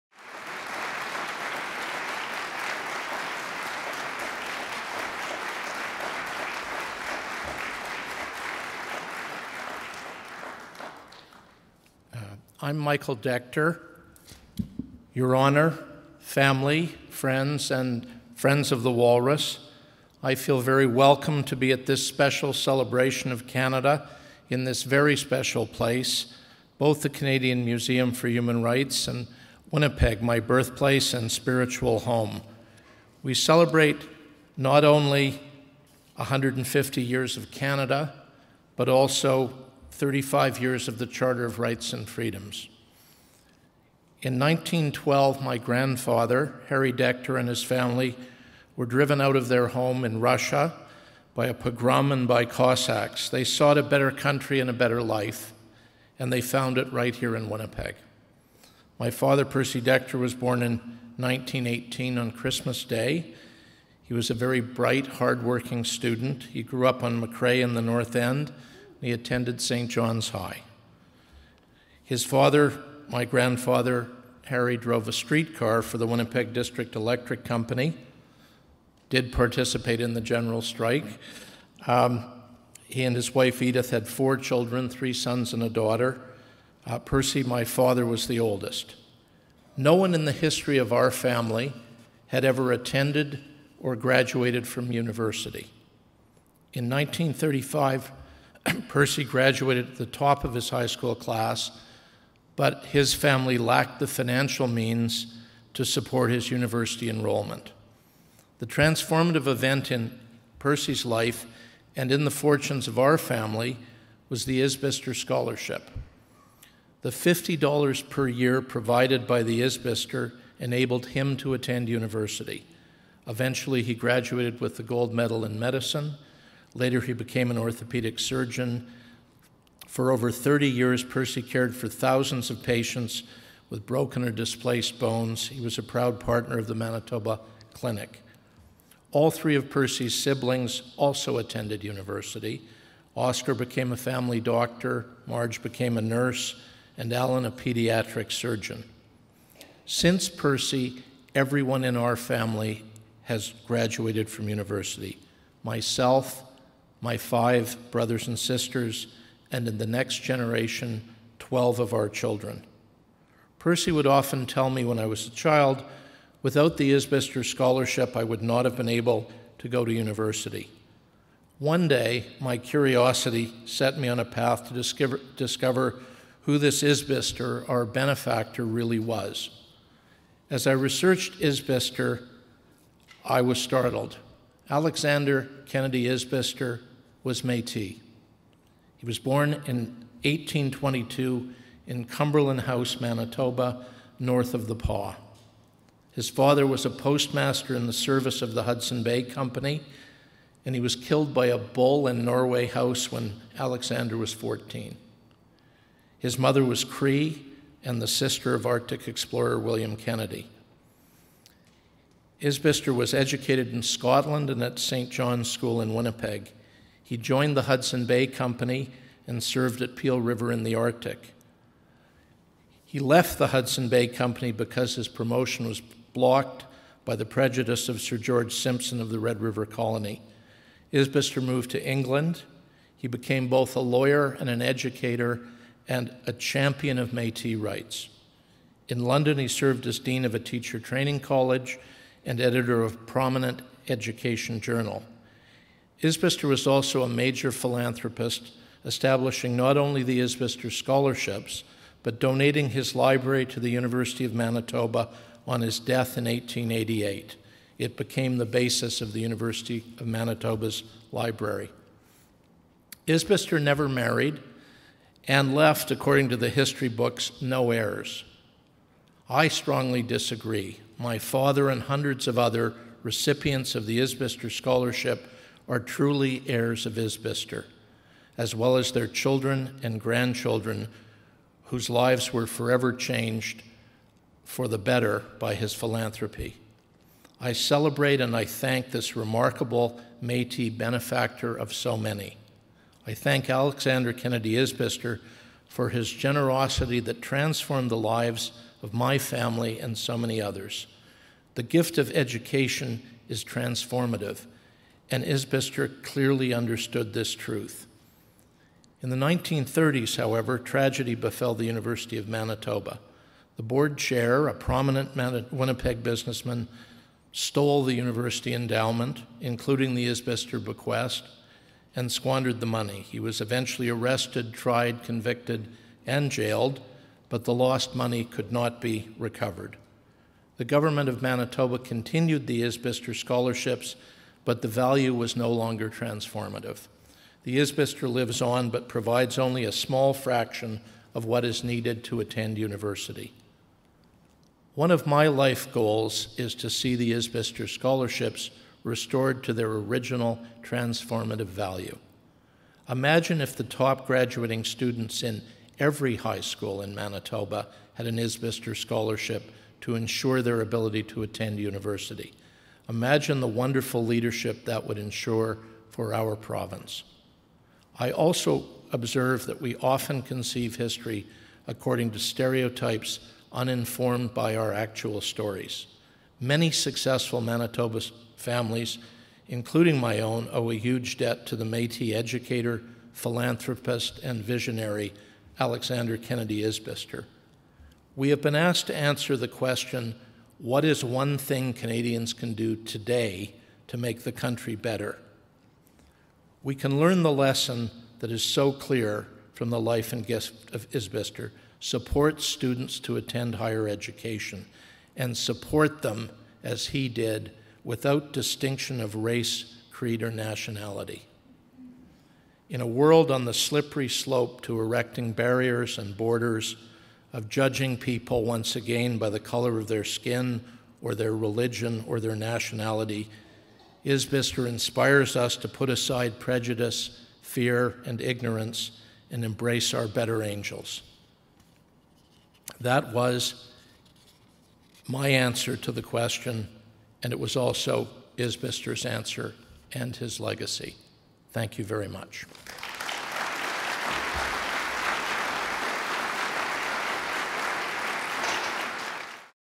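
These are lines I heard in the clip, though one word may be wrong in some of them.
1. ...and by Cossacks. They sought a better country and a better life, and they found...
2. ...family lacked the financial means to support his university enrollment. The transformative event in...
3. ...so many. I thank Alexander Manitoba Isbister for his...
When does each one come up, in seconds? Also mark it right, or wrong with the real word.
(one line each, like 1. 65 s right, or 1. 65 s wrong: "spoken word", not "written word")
1. 52 s right
2. 103 s right
3. 291 s wrong: "Kennedy", not "Manitoba".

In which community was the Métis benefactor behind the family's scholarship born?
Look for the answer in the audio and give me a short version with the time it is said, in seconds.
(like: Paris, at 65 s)
Cumberland House, at 192 s.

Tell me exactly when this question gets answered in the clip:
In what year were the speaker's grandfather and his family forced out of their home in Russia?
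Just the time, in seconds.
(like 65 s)
44 s.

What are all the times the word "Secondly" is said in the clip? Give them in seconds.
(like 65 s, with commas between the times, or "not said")
not said.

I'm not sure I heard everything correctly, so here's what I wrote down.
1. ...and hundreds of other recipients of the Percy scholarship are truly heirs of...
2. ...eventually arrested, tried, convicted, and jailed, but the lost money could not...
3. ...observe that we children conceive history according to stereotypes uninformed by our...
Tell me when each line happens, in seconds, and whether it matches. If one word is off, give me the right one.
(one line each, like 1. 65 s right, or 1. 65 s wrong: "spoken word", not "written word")
1. 271 s wrong: "Isbister", not "Percy"
2. 323 s right
3. 368 s wrong: "often", not "children".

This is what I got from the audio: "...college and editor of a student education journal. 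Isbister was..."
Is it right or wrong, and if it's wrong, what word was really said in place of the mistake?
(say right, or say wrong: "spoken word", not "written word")
wrong: "prominent", not "student".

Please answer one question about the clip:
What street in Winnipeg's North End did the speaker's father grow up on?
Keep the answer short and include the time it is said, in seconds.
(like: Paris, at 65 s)
McRae, at 67 s.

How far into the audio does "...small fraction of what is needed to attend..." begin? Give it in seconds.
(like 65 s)
339 s.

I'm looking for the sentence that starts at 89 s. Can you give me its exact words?
No one in the history of our family had ever attended or graduated from university.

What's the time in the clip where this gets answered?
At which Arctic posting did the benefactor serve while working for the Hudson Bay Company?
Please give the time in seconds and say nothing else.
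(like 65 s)
219 s.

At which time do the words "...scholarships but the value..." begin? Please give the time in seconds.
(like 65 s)
333 s.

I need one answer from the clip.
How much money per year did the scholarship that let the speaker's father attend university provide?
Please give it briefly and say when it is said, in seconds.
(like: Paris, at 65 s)
$50, at 117 s.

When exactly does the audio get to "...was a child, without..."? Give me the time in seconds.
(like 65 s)
165 s.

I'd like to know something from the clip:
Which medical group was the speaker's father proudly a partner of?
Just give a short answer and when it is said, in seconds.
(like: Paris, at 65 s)
Manitoba Clinic, at 136 s.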